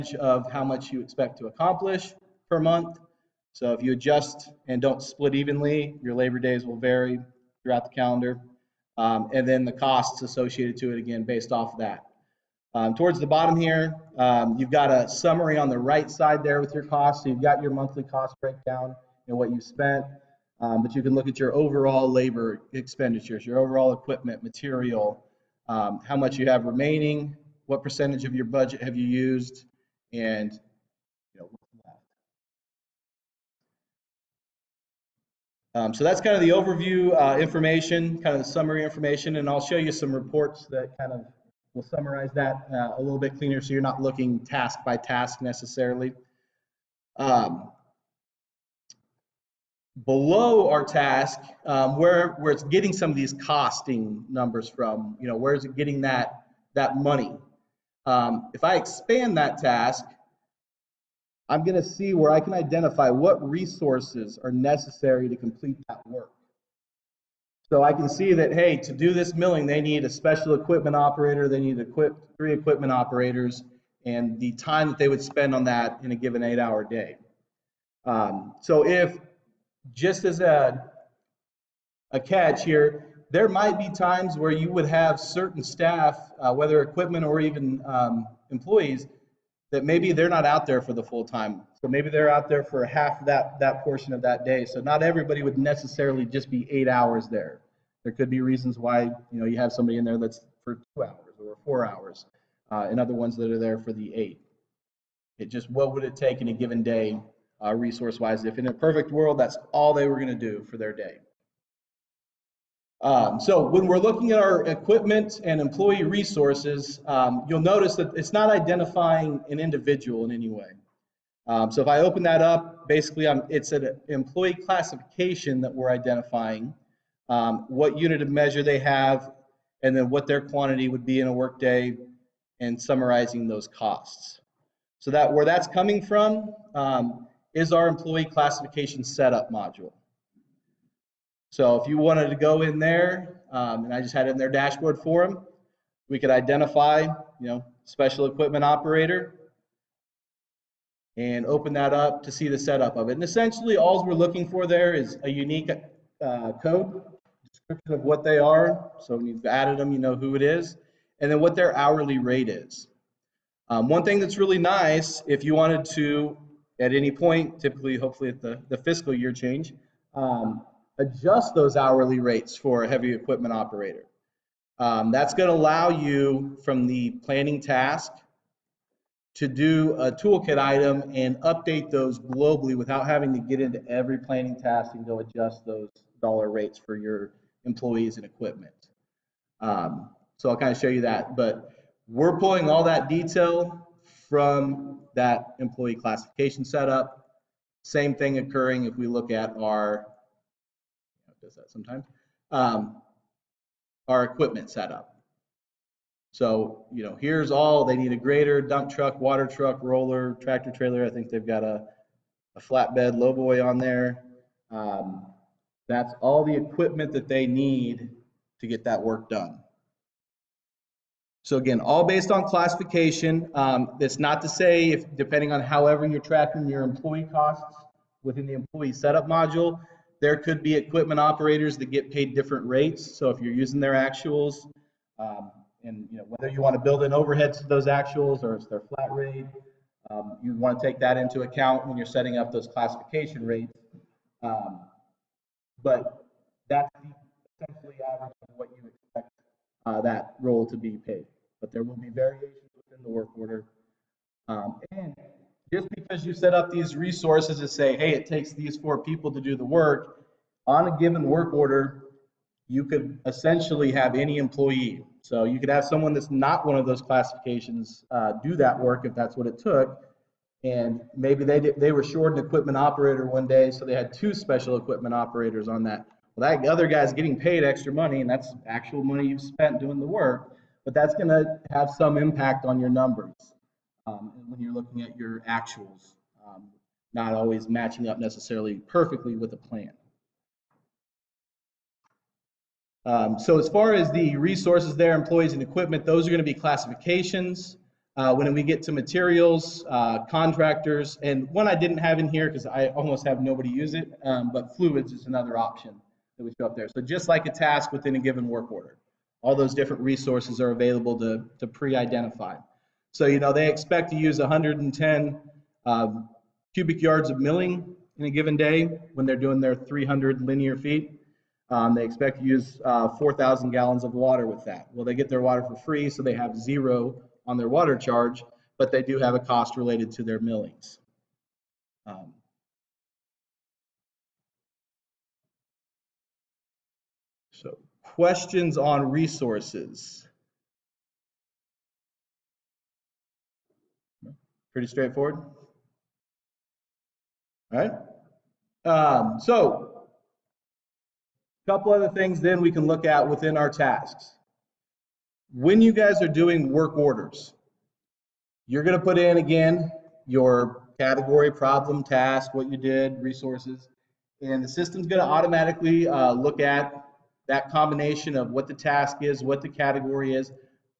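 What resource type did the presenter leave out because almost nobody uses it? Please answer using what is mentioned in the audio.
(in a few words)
Fluids.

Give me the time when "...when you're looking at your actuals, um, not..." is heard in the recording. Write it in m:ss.
4:44.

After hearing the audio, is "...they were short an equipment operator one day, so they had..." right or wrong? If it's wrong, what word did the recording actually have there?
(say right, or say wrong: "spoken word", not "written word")
right.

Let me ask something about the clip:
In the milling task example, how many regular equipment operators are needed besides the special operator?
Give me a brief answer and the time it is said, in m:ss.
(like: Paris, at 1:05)
3, at 1:12.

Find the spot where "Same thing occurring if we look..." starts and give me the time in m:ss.
3:17.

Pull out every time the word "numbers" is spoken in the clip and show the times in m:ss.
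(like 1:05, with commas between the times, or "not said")
0:54, 4:42.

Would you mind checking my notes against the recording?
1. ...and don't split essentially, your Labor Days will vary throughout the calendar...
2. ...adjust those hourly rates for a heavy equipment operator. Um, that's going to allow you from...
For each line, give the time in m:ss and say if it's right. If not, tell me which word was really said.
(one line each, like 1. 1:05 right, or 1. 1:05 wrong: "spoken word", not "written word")
1. 0:04 wrong: "evenly", not "essentially"
2. 2:50 right.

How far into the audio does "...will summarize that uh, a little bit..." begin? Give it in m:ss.
0:41.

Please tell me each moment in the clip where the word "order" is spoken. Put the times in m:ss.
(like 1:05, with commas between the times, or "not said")
4:13, 4:21, 5:08, 5:56.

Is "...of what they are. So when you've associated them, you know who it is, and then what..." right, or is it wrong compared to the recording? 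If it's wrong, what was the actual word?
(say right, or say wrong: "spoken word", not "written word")
wrong: "added", not "associated".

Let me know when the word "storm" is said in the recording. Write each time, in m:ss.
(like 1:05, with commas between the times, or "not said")
not said.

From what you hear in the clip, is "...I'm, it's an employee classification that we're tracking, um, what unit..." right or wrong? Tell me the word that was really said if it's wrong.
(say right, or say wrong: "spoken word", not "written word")
wrong: "identifying", not "tracking".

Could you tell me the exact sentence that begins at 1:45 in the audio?
It just what would it take in a given day, uh, resource wise?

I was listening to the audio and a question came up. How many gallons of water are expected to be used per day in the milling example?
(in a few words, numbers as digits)
4,000.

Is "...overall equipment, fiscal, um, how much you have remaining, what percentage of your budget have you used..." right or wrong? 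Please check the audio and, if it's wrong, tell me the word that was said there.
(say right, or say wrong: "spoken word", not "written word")
wrong: "material", not "fiscal".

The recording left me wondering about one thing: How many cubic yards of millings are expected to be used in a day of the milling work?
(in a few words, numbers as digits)
110.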